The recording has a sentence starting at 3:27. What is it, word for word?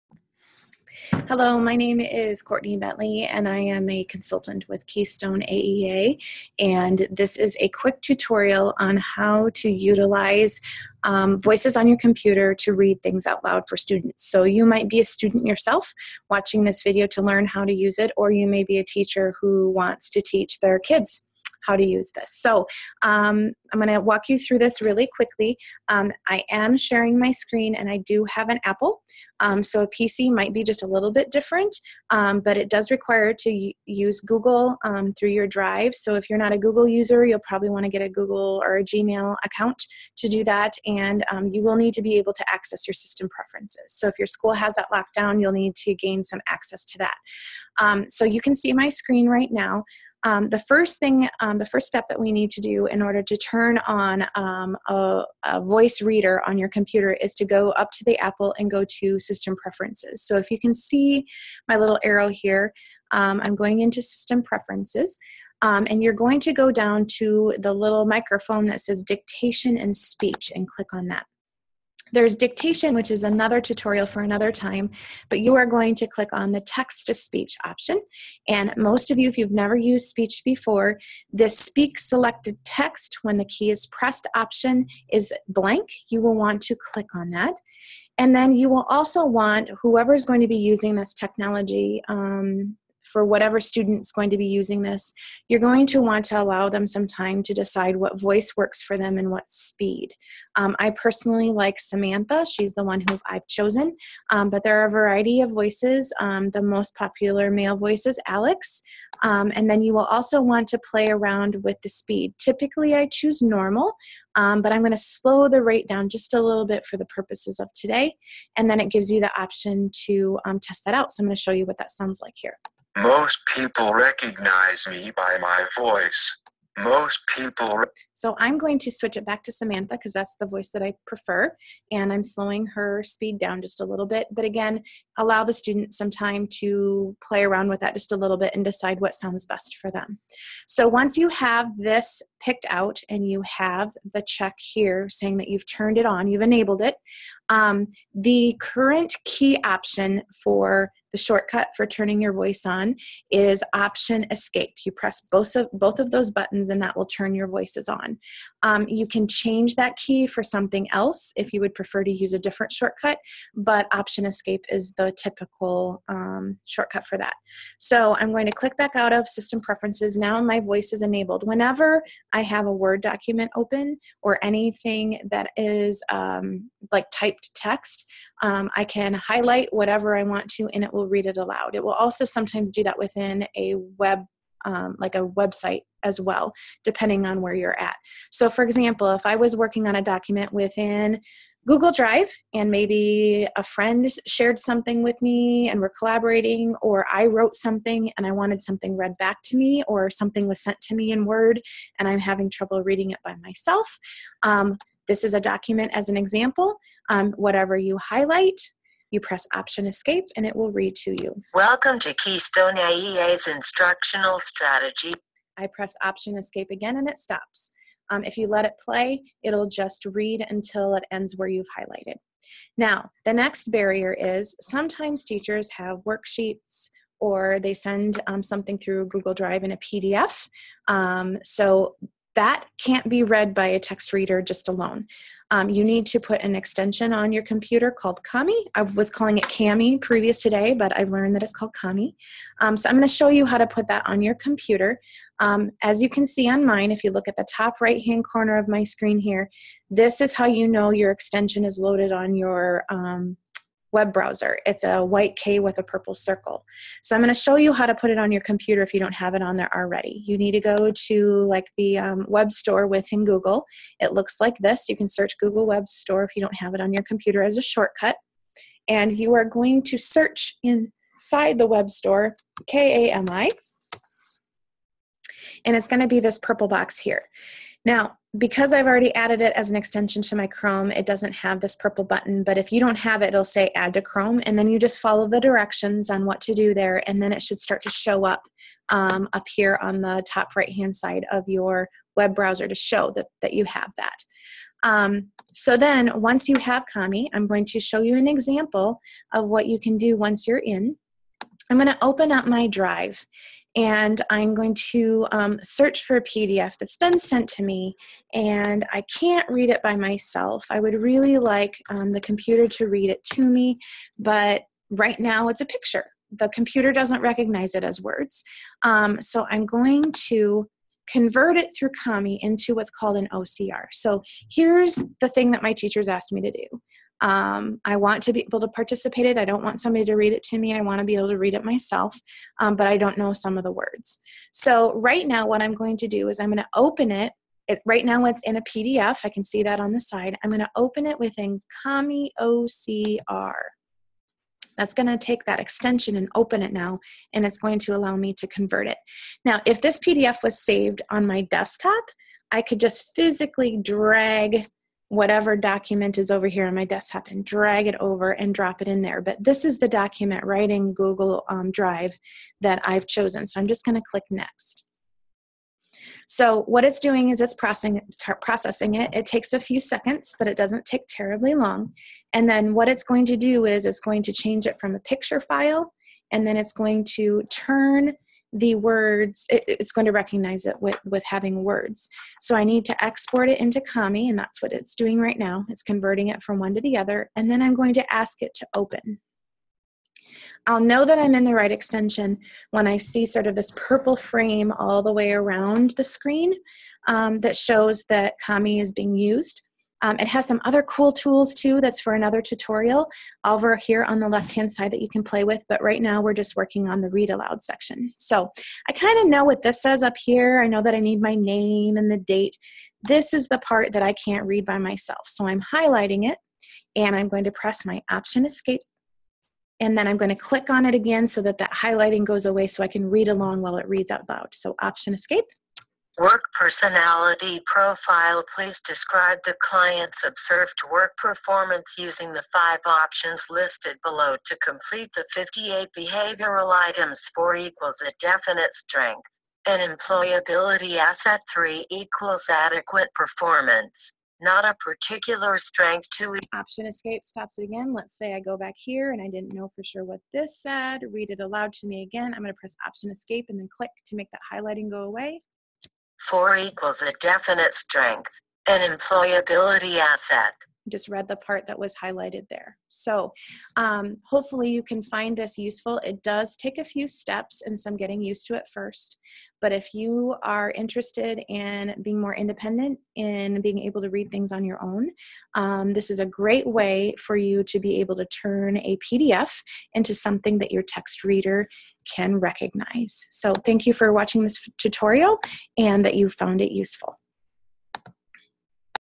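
Um, whatever you highlight, you press Option Escape and it will read to you.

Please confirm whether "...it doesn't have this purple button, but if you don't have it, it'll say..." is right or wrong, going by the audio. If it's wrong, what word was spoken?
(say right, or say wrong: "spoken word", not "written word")
right.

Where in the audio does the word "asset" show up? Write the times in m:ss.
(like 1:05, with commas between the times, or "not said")
7:20, 7:39.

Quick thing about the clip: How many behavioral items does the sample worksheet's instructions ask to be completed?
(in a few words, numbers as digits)
58.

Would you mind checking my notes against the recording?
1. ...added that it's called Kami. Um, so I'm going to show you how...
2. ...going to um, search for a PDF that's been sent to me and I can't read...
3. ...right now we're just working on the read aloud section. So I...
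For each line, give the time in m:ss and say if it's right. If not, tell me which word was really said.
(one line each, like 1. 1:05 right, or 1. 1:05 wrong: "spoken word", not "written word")
1. 4:01 wrong: "learned", not "added"
2. 5:04 right
3. 6:45 right.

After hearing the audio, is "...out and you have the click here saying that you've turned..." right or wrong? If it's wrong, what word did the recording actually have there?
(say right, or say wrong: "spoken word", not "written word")
wrong: "check", not "click".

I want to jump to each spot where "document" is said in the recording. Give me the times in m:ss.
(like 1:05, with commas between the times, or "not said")
2:53, 3:10, 3:25, 5:55, 5:59.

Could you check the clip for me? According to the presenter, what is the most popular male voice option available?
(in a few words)
Alex.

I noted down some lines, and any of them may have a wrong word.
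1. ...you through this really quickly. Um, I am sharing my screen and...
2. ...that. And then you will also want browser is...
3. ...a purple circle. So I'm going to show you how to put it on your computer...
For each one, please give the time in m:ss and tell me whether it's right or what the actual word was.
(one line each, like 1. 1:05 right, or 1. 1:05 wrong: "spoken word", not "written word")
1. 0:24 right
2. 1:27 wrong: "whoever", not "browser"
3. 4:15 right.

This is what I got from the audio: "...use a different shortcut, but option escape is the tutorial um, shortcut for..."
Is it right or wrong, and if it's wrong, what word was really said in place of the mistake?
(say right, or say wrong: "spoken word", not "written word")
wrong: "typical", not "tutorial".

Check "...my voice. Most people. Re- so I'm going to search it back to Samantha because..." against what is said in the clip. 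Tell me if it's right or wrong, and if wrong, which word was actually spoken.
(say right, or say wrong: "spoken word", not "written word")
wrong: "switch", not "search".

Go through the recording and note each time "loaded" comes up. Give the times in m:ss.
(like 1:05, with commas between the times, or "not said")
4:11.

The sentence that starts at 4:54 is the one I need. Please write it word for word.
Um, so then once you have Kami, I'm going to show you an example of what you can do once you're in.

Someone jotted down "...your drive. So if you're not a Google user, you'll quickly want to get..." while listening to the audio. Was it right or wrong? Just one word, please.
wrong.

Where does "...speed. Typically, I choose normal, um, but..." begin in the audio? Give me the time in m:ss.
1:51.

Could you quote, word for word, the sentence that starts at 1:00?
So if you can see my little arrow here, um, I'm going into System Preferences.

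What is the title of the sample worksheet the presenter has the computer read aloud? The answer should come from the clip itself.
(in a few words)
Work personality profile.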